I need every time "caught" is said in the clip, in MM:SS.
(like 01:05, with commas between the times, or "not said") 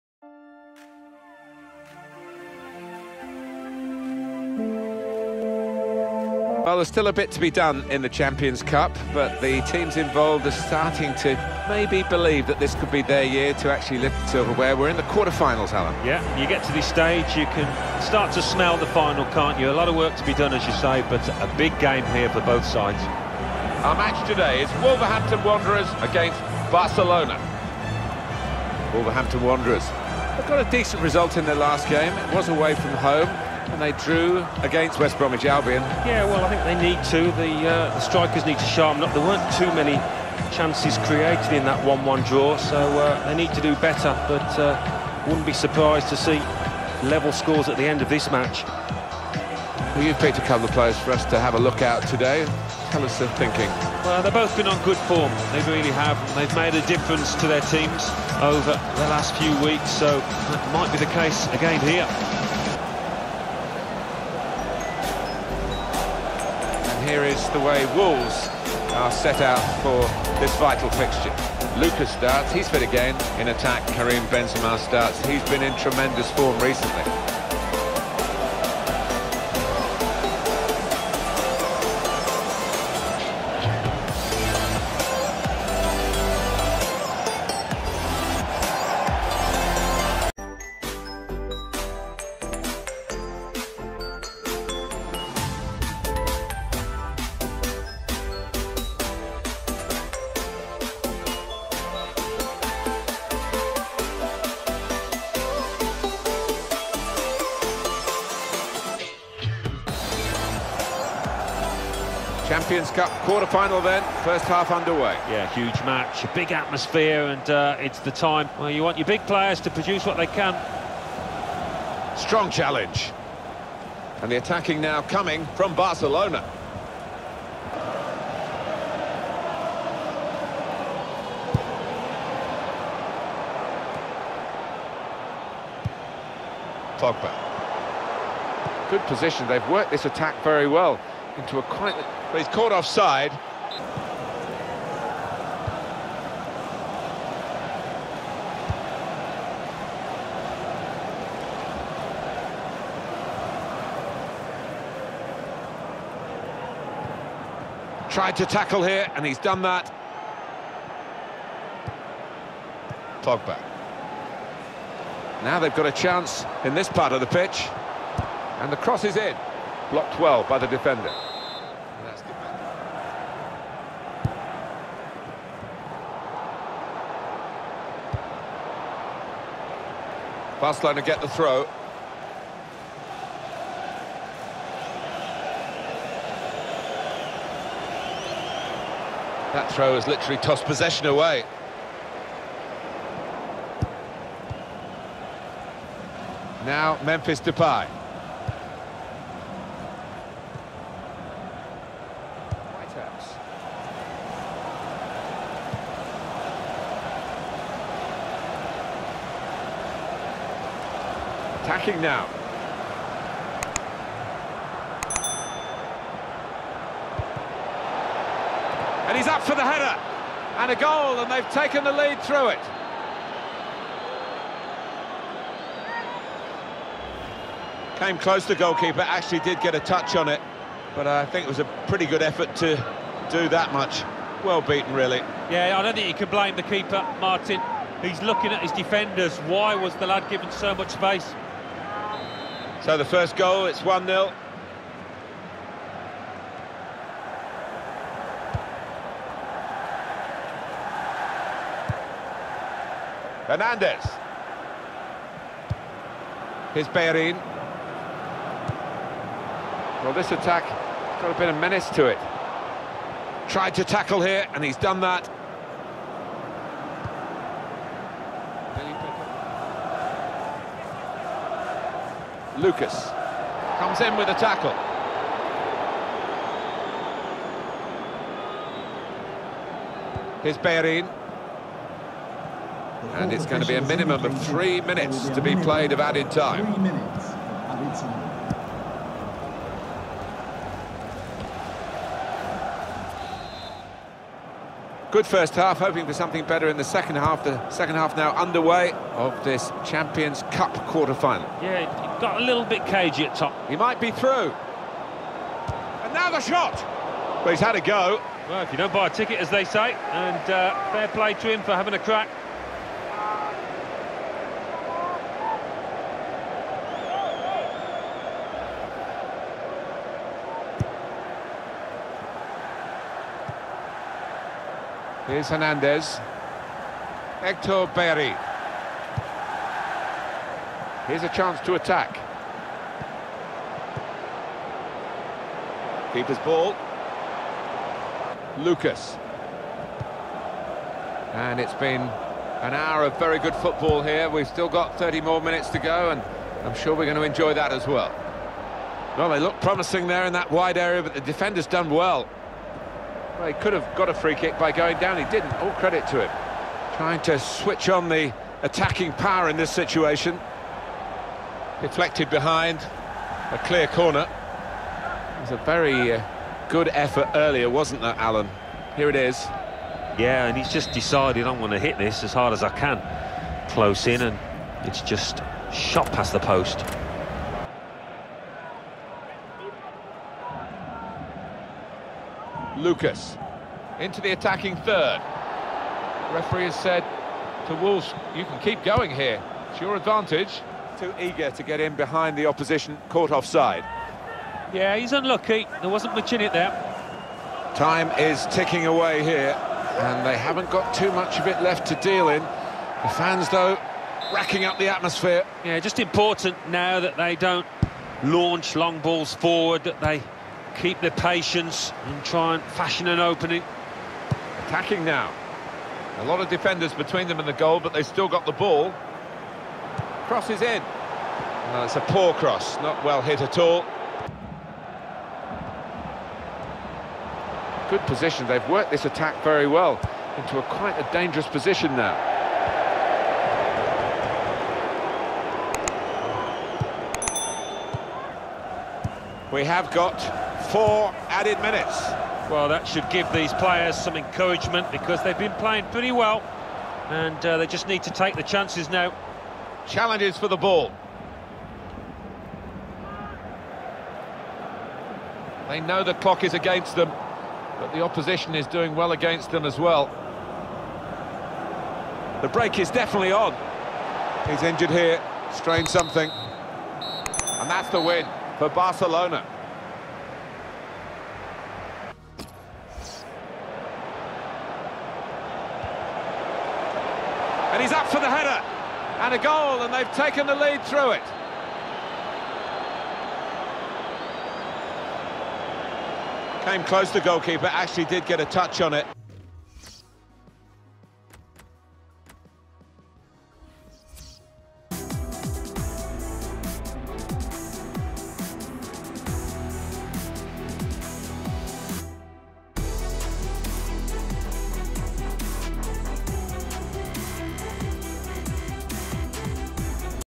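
02:22, 06:33.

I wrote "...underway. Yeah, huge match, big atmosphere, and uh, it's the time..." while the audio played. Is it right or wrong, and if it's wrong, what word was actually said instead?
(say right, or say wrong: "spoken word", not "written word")
right.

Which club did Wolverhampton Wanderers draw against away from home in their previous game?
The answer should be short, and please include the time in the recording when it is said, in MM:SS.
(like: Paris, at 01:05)
West Bromwich Albion, at 00:34.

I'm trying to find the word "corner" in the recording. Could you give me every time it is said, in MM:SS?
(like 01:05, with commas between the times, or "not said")
06:03.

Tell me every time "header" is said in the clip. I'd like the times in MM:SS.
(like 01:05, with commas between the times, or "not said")
03:39, 07:58.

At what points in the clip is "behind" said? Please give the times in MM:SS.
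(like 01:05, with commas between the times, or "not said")
06:02, 06:31.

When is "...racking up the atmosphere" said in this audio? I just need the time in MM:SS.
06:44.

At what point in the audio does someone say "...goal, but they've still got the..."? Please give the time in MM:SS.
06:57.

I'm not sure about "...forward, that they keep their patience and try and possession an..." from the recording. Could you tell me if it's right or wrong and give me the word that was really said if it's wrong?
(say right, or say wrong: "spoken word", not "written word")
wrong: "fashion", not "possession".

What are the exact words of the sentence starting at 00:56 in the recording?
They've made a difference to their teams over the last few weeks, so that might be the case again here.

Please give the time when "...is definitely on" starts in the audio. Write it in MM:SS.
07:42.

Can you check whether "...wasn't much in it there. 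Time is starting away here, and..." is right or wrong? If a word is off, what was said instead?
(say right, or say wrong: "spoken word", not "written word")
wrong: "ticking", not "starting".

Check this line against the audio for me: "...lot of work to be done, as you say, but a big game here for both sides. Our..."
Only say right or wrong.
right.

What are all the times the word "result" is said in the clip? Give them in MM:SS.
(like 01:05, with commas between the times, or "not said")
00:31.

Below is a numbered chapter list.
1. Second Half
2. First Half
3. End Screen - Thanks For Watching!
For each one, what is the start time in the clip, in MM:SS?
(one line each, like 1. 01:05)
1. 04:55
2. 01:52
3. 08:16.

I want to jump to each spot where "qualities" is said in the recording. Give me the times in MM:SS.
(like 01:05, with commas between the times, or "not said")
not said.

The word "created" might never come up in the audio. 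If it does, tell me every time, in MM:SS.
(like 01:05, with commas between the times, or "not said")
00:41.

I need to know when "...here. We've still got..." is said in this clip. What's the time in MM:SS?
05:44.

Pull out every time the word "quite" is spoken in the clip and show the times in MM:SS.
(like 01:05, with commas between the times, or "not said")
02:21, 07:10.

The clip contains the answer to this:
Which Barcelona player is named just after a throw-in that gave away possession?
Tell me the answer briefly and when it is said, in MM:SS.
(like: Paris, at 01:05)
Memphis Depay, at 03:17.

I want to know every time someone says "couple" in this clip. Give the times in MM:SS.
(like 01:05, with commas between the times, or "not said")
00:50.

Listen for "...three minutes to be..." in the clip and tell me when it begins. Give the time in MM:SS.
04:44.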